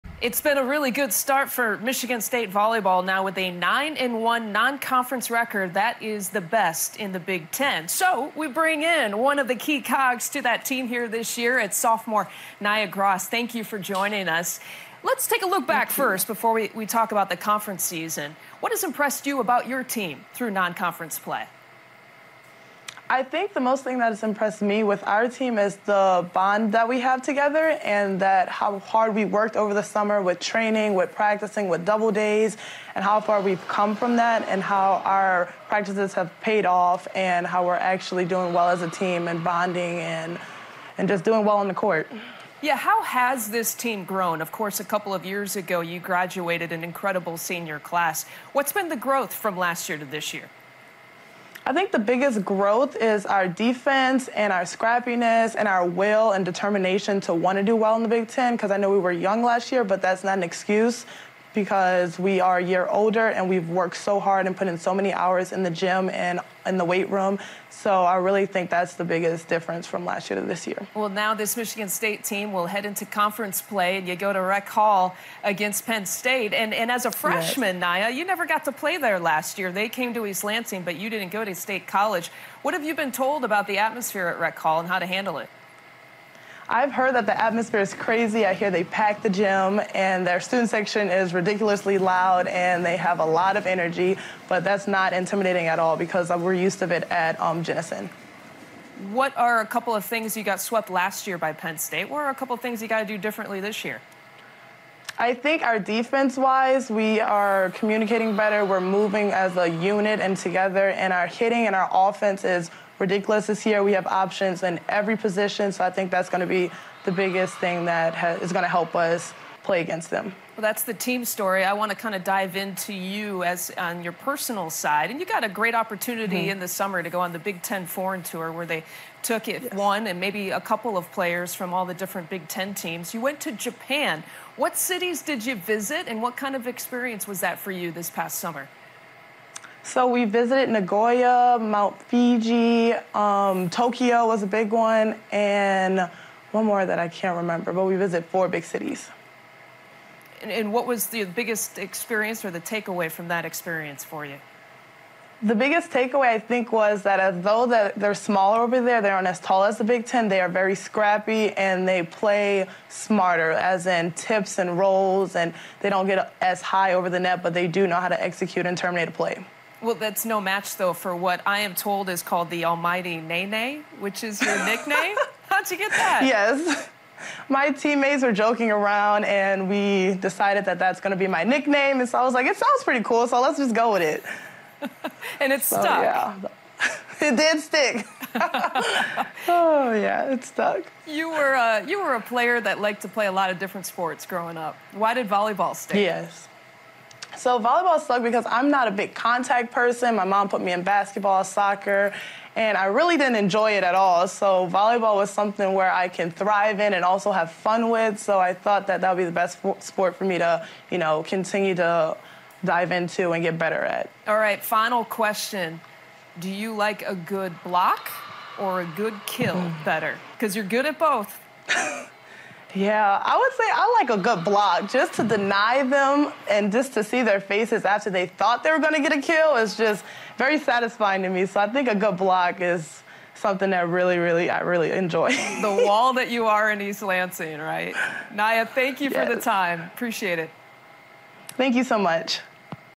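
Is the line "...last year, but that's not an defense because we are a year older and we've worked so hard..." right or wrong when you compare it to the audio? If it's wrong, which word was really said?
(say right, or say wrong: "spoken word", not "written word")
wrong: "excuse", not "defense".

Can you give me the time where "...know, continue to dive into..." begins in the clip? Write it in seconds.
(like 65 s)
210 s.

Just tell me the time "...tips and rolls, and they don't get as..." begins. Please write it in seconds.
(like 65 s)
164 s.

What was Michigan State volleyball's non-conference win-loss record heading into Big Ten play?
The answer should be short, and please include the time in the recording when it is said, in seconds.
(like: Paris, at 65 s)
9-1, at 3 s.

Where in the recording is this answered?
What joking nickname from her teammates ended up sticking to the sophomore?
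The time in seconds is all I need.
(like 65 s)
172 s.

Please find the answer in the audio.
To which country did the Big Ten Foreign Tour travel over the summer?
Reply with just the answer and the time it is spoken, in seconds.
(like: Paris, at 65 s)
Japan, at 133 s.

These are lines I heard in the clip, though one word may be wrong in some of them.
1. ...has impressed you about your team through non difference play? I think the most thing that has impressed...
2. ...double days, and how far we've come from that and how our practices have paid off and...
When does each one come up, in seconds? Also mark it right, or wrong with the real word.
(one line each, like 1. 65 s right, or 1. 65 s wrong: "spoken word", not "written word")
1. 18 s wrong: "conference", not "difference"
2. 31 s right.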